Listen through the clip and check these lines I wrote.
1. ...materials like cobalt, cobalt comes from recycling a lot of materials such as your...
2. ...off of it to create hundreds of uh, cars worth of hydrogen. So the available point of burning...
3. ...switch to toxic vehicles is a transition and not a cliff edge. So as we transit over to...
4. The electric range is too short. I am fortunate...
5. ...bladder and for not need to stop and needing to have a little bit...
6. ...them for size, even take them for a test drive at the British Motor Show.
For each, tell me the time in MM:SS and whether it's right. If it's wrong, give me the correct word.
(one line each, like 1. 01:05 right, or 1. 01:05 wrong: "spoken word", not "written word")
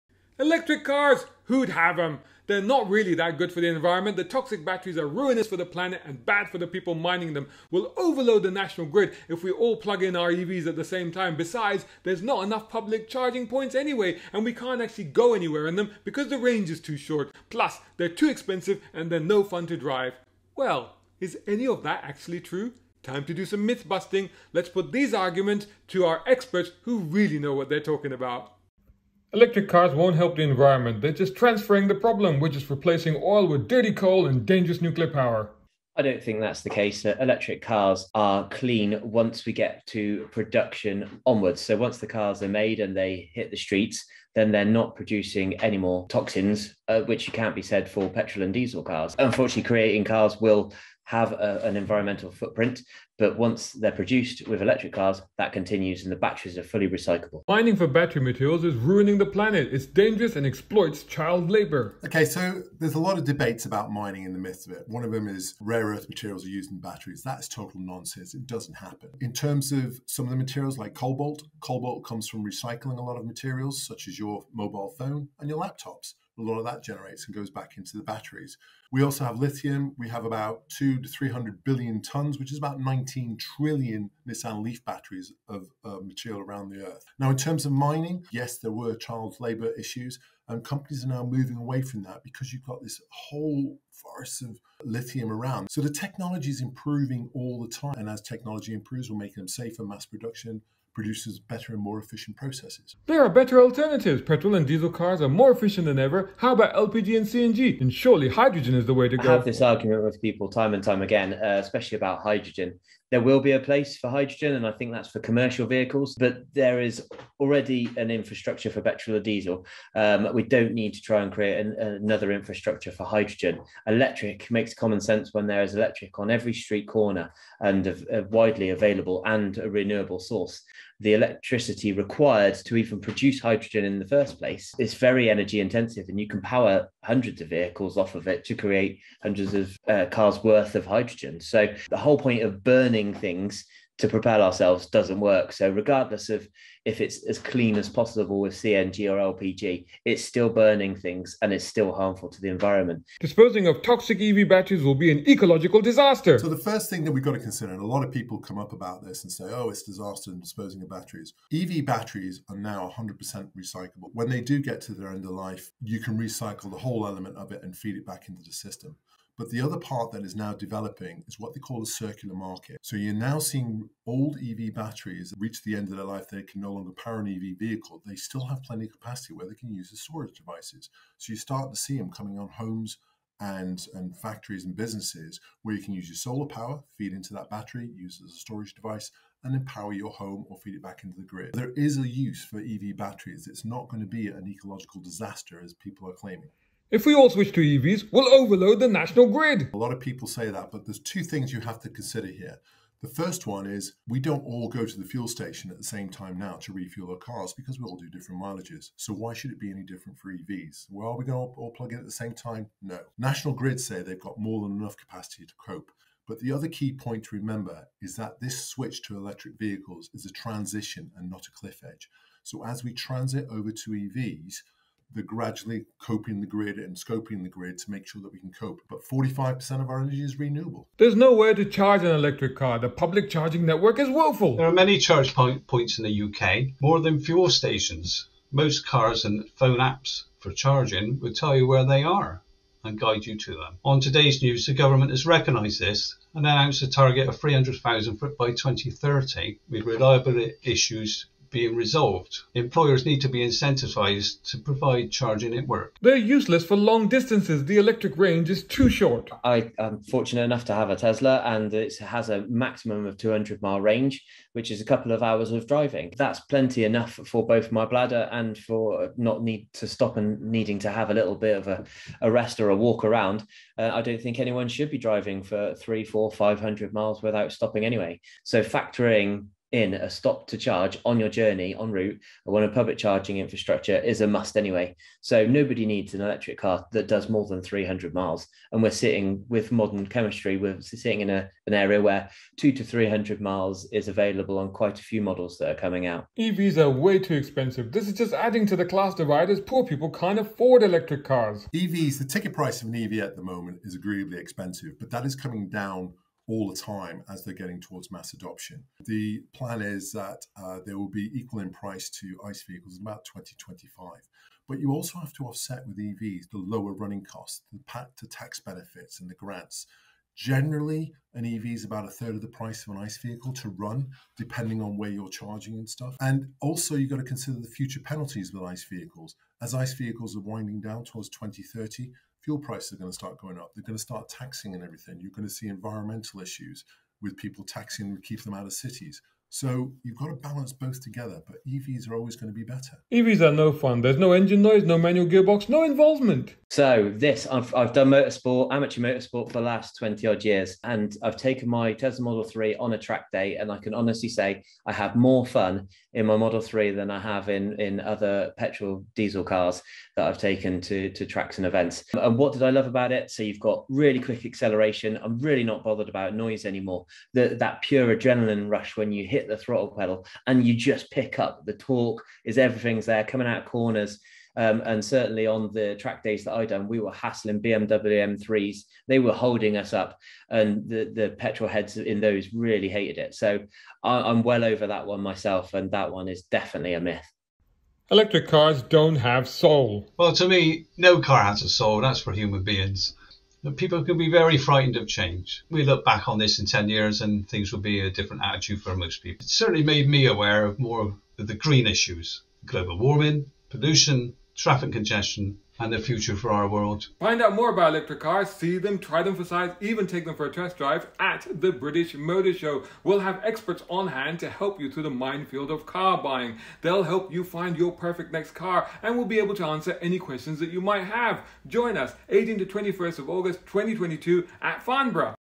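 1. 01:10 right
2. 02:17 wrong: "whole", not "available"
3. 03:38 wrong: "electric", not "toxic"
4. 04:17 right
5. 04:27 right
6. 06:49 right.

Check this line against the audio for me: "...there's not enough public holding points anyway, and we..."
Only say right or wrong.
wrong.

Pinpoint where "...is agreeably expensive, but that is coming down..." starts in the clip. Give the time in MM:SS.
05:03.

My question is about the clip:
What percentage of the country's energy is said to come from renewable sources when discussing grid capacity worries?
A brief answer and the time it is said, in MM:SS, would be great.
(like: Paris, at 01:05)
45%, at 03:49.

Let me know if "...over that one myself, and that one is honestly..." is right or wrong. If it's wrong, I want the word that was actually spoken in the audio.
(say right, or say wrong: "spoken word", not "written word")
wrong: "definitely", not "honestly".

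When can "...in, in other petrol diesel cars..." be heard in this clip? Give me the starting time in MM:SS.
05:57.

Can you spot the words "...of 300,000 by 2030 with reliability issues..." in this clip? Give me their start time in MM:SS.
04:07.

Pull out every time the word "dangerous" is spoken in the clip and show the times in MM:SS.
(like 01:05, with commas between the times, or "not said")
00:34, 00:59.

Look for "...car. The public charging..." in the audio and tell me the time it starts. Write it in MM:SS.
03:52.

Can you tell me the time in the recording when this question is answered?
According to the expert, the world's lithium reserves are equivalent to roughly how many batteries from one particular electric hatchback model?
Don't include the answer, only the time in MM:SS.
01:22.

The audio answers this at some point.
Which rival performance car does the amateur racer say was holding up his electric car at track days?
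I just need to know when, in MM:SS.
06:17.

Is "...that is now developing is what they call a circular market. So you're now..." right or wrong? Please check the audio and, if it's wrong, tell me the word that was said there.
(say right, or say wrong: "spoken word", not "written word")
right.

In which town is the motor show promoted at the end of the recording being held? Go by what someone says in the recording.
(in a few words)
Farnborough.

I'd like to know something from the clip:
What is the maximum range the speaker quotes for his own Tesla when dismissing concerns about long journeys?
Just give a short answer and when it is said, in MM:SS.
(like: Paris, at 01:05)
200 miles, at 04:23.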